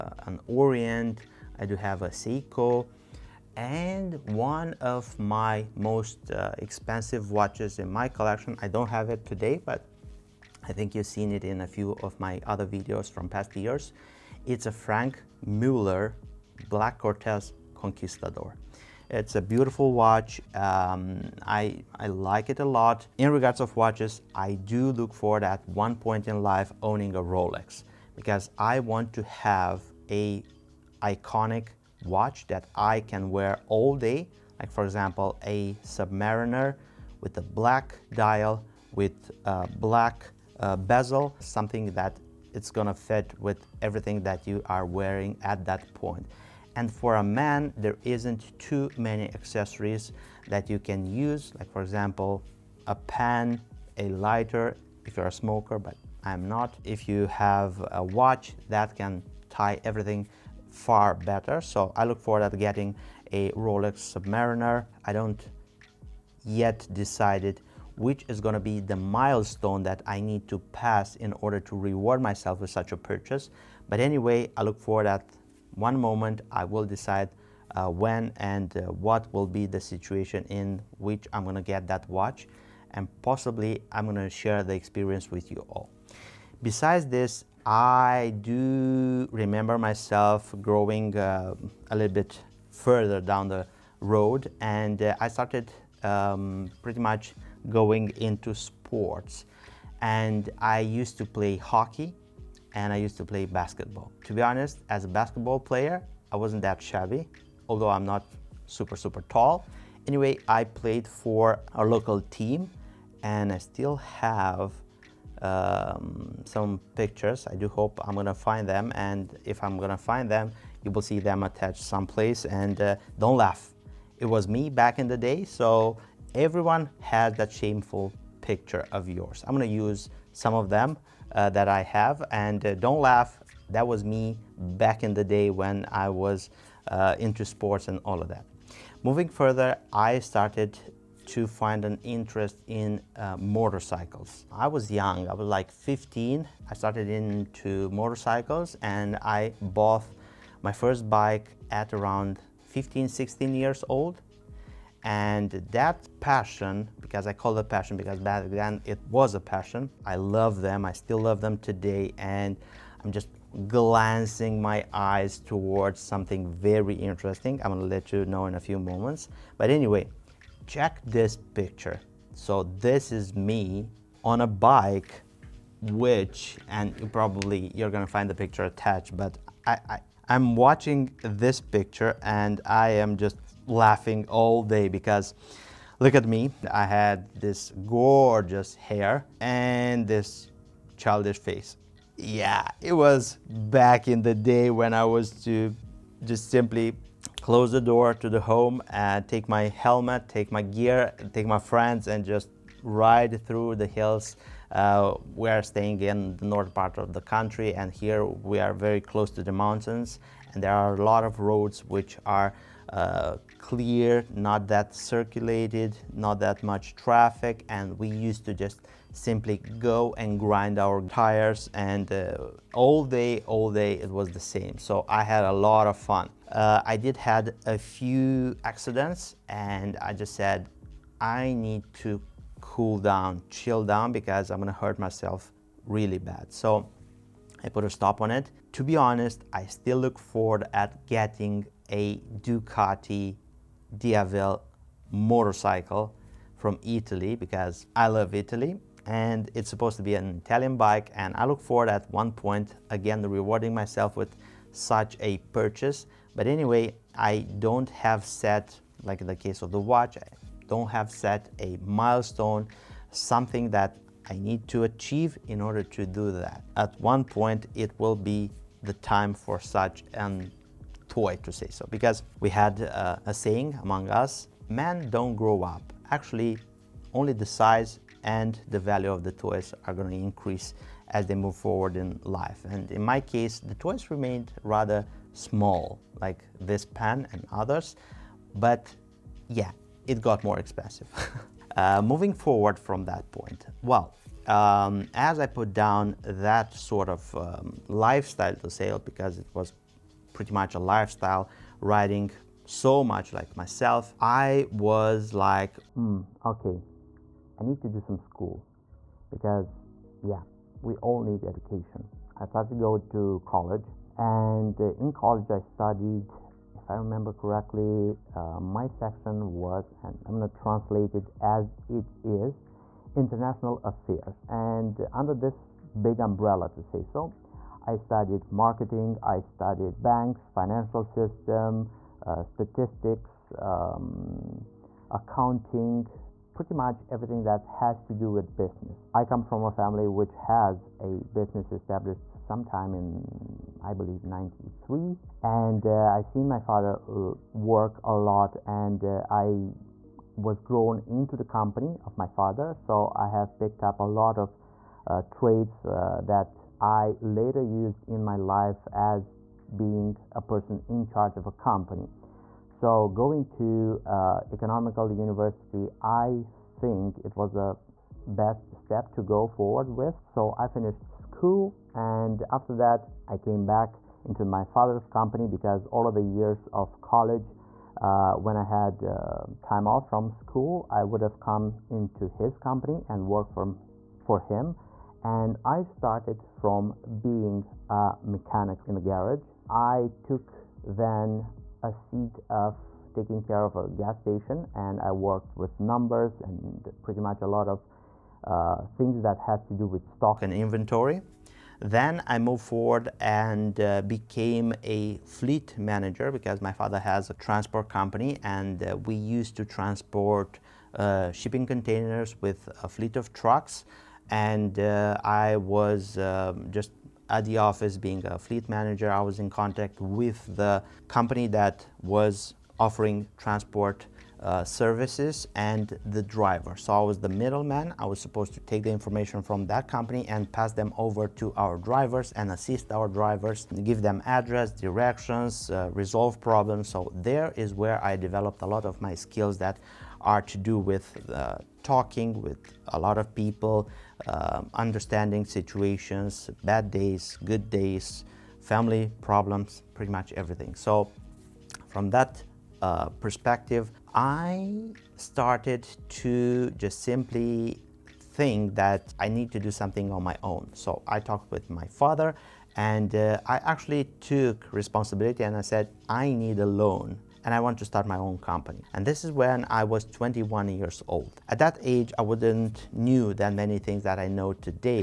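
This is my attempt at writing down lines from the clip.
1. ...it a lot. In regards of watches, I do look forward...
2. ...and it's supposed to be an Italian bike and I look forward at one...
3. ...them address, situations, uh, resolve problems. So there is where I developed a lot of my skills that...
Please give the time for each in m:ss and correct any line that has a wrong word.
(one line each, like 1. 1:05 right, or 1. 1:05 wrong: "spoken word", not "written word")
1. 0:22 right
2. 4:09 right
3. 7:14 wrong: "directions", not "situations".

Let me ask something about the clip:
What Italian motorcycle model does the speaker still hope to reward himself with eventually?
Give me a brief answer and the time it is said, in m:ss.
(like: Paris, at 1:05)
Ducati Diavel, at 4:02.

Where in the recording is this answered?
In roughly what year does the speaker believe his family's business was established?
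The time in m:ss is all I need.
5:44.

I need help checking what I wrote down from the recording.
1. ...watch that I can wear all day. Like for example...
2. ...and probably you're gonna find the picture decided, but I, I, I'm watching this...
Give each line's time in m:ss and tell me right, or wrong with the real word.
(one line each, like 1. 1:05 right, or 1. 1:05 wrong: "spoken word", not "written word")
1. 0:32 right
2. 2:56 wrong: "attached", not "decided".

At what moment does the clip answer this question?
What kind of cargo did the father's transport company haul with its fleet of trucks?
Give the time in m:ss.
6:51.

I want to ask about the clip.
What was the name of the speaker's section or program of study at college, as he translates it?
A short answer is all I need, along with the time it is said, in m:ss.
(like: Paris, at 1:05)
International affairs, at 5:23.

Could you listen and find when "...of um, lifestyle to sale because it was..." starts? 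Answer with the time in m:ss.
4:57.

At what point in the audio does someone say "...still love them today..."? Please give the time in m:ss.
2:40.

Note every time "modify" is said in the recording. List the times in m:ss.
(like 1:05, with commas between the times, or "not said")
not said.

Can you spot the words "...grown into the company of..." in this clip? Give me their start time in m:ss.
5:50.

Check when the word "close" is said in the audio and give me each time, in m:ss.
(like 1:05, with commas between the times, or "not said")
3:17, 3:29.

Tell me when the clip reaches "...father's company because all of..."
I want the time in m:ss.
6:14.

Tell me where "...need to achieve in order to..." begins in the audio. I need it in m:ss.
4:24.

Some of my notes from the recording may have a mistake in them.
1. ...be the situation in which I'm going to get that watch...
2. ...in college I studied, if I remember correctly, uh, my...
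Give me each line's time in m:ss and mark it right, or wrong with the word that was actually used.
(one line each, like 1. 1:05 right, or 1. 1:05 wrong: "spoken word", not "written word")
1. 1:19 right
2. 5:15 right.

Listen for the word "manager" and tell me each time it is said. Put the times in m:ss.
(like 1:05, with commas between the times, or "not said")
6:45, 6:58.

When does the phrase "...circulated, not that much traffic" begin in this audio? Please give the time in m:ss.
3:34.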